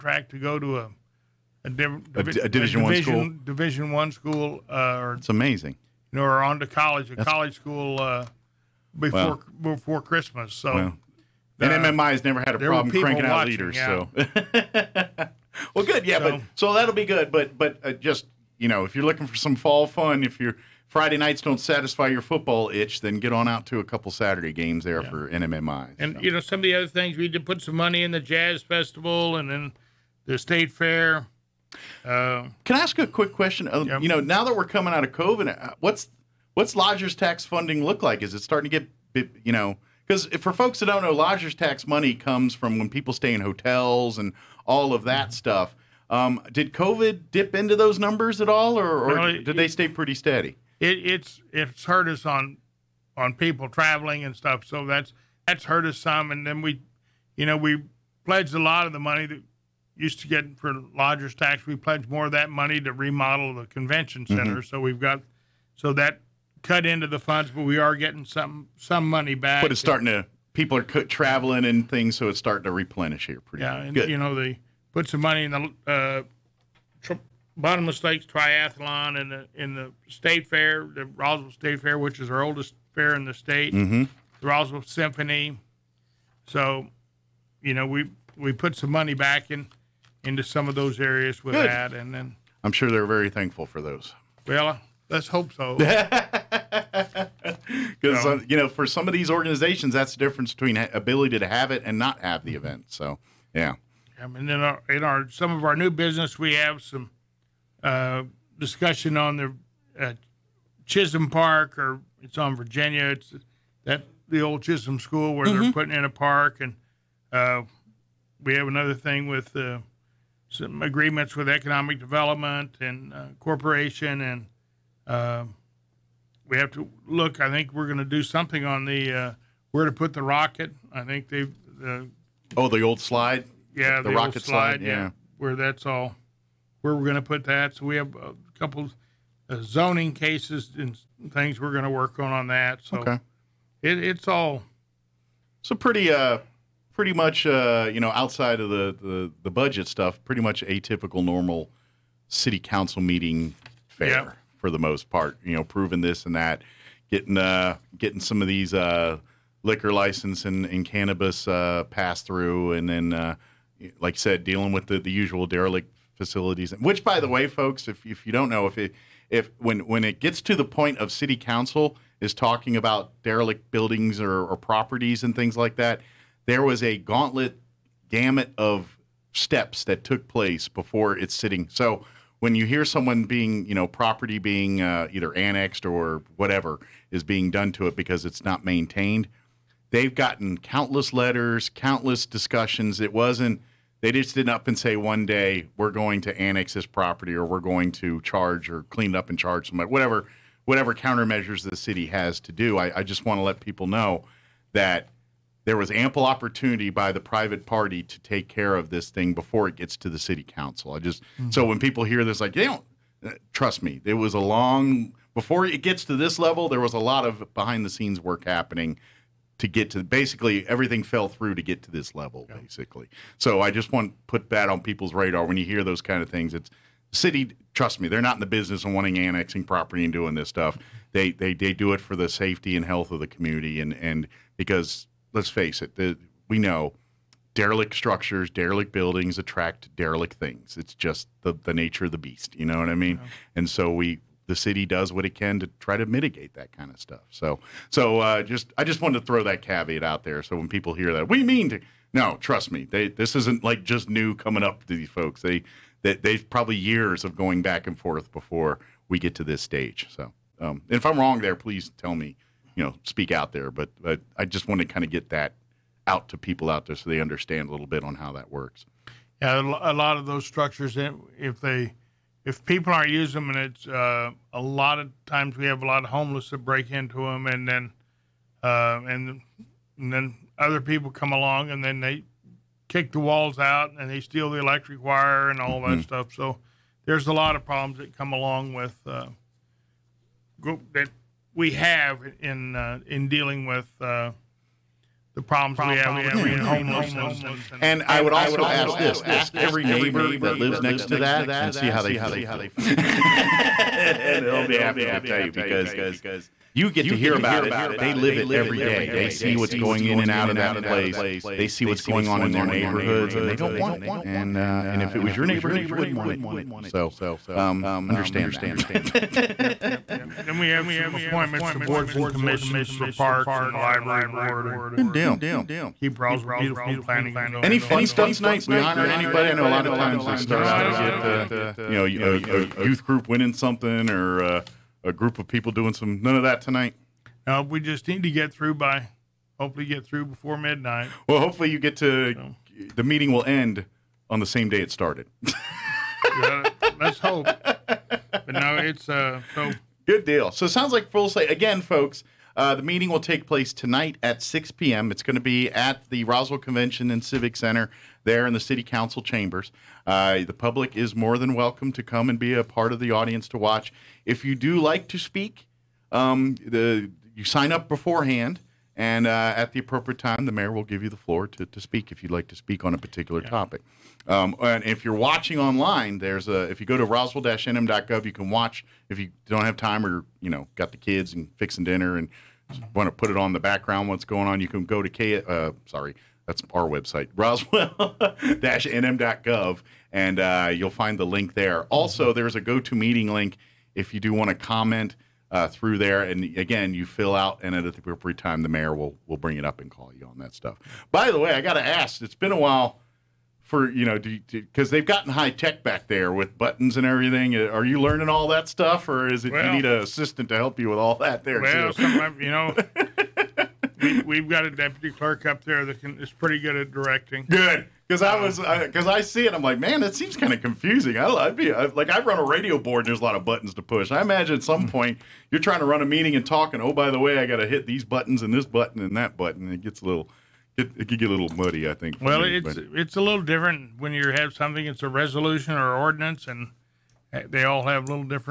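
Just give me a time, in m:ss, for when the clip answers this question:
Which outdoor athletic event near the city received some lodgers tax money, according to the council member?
1:17.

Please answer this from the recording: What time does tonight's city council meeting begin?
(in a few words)
6 p.m.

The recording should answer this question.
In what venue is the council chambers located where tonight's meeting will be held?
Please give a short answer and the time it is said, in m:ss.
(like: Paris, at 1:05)
Roswell Convention and Civic Center, at 5:56.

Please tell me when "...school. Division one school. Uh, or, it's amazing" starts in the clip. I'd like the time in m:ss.
0:03.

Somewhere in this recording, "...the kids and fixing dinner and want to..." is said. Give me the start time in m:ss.
6:20.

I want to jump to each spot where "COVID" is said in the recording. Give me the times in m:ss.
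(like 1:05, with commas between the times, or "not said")
0:35, 0:46.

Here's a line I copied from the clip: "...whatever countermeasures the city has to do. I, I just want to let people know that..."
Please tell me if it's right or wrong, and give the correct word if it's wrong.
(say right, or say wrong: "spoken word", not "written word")
right.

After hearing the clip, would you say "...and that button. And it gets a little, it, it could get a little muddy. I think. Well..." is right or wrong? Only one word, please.
right.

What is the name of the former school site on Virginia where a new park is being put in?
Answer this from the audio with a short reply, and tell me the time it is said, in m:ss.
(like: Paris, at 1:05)
Chisholm School, at 1:54.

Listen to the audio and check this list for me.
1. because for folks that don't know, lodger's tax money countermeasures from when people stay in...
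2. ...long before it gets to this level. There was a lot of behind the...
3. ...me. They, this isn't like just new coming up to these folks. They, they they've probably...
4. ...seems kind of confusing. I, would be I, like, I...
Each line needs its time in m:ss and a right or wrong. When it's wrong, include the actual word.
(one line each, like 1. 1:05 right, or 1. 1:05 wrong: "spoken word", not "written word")
1. 0:40 wrong: "comes", not "countermeasures"
2. 3:34 right
3. 4:12 right
4. 7:00 right.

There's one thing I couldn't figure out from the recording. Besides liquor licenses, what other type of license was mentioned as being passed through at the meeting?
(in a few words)
cannabis.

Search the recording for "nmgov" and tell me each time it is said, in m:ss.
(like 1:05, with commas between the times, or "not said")
6:17, 6:27.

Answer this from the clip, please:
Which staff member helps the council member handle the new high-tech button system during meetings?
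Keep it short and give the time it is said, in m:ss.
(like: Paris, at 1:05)
deputy clerk, at 6:54.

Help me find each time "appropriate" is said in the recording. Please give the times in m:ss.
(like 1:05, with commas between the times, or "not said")
6:09, 6:37.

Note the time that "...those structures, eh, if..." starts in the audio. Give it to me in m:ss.
4:30.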